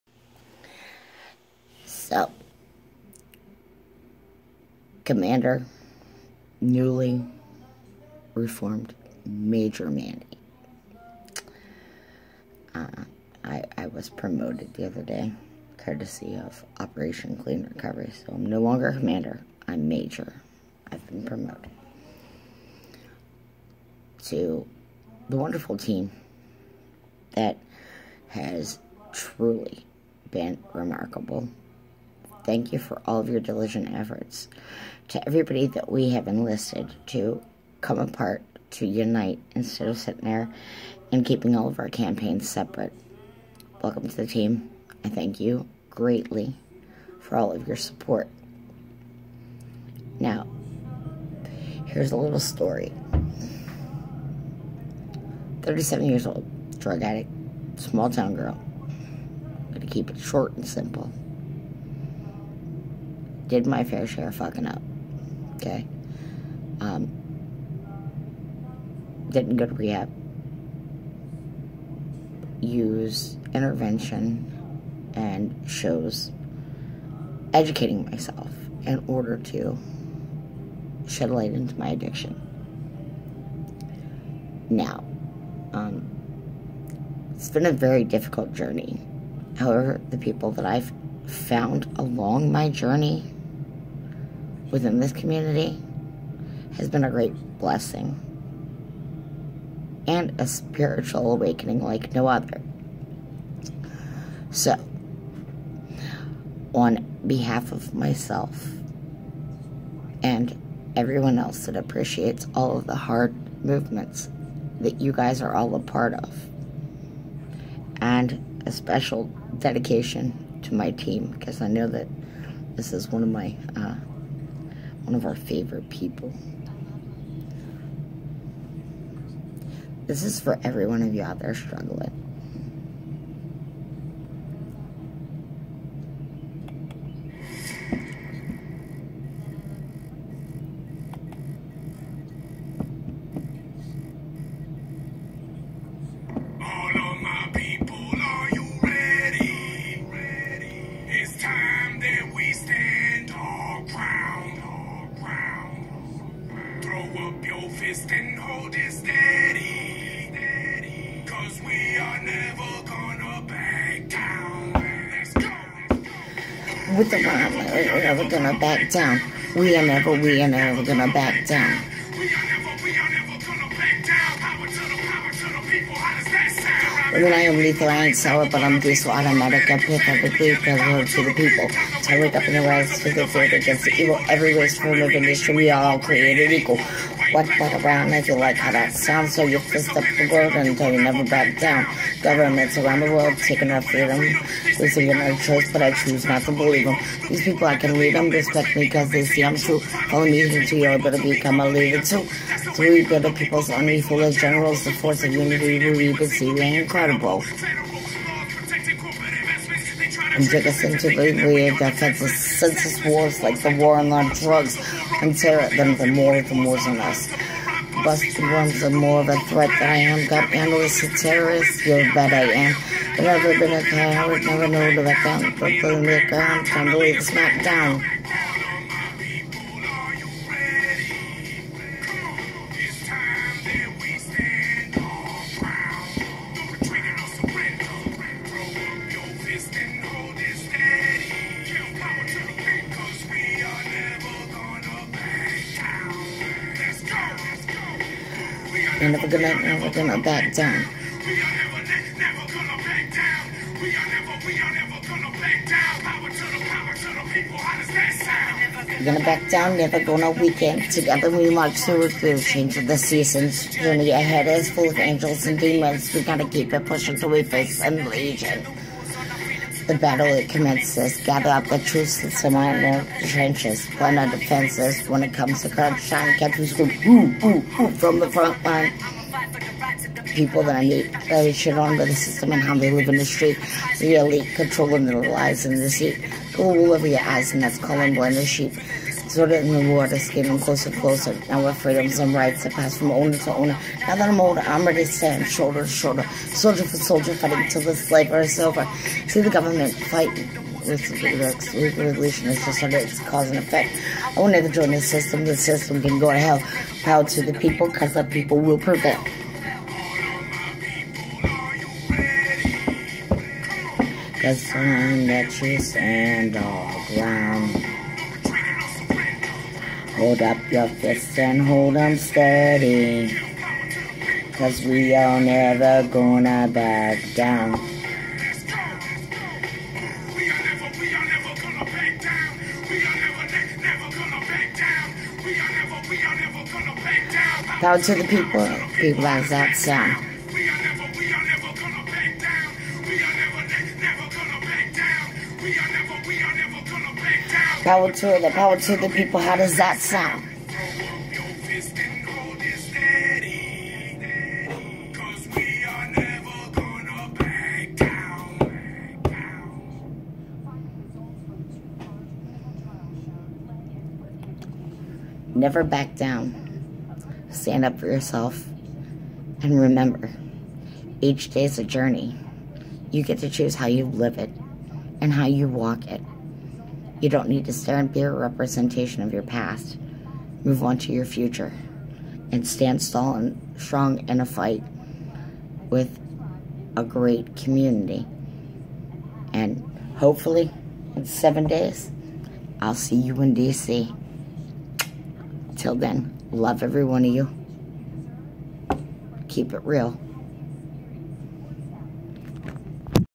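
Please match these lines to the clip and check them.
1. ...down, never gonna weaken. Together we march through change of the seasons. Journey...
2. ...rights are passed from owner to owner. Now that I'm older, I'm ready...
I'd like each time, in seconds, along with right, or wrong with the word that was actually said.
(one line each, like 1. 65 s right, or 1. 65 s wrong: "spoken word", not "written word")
1. 259 s right
2. 292 s right.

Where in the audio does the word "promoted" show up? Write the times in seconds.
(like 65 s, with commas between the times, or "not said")
14 s, 21 s.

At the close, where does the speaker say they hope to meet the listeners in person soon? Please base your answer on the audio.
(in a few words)
D.C.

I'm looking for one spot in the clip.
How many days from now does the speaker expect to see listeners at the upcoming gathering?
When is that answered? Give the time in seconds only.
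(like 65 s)
391 s.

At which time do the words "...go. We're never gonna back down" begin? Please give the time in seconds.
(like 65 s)
165 s.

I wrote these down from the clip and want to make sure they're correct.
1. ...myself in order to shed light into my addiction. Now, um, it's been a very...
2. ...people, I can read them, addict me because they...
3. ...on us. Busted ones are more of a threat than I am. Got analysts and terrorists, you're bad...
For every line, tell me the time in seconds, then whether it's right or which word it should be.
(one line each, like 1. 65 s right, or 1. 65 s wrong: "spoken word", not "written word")
1. 78 s right
2. 197 s wrong: "respect", not "addict"
3. 216 s right.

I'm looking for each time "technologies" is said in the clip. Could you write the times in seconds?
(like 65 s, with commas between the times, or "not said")
not said.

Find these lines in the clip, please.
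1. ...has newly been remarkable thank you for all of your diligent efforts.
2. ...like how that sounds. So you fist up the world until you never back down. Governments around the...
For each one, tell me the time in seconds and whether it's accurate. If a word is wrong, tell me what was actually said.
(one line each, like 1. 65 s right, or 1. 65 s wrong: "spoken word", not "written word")
1. 28 s wrong: "truly", not "newly"
2. 188 s right.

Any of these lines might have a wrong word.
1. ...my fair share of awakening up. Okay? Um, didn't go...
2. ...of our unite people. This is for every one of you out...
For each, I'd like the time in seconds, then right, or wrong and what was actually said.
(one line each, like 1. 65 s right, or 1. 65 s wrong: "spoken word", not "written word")
1. 63 s wrong: "fucking", not "awakening"
2. 125 s wrong: "favorite", not "unite".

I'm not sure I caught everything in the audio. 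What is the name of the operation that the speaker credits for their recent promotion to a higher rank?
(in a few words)
Operation Clean Recovery.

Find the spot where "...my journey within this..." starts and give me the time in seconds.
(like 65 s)
92 s.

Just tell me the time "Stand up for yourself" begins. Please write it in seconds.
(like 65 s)
367 s.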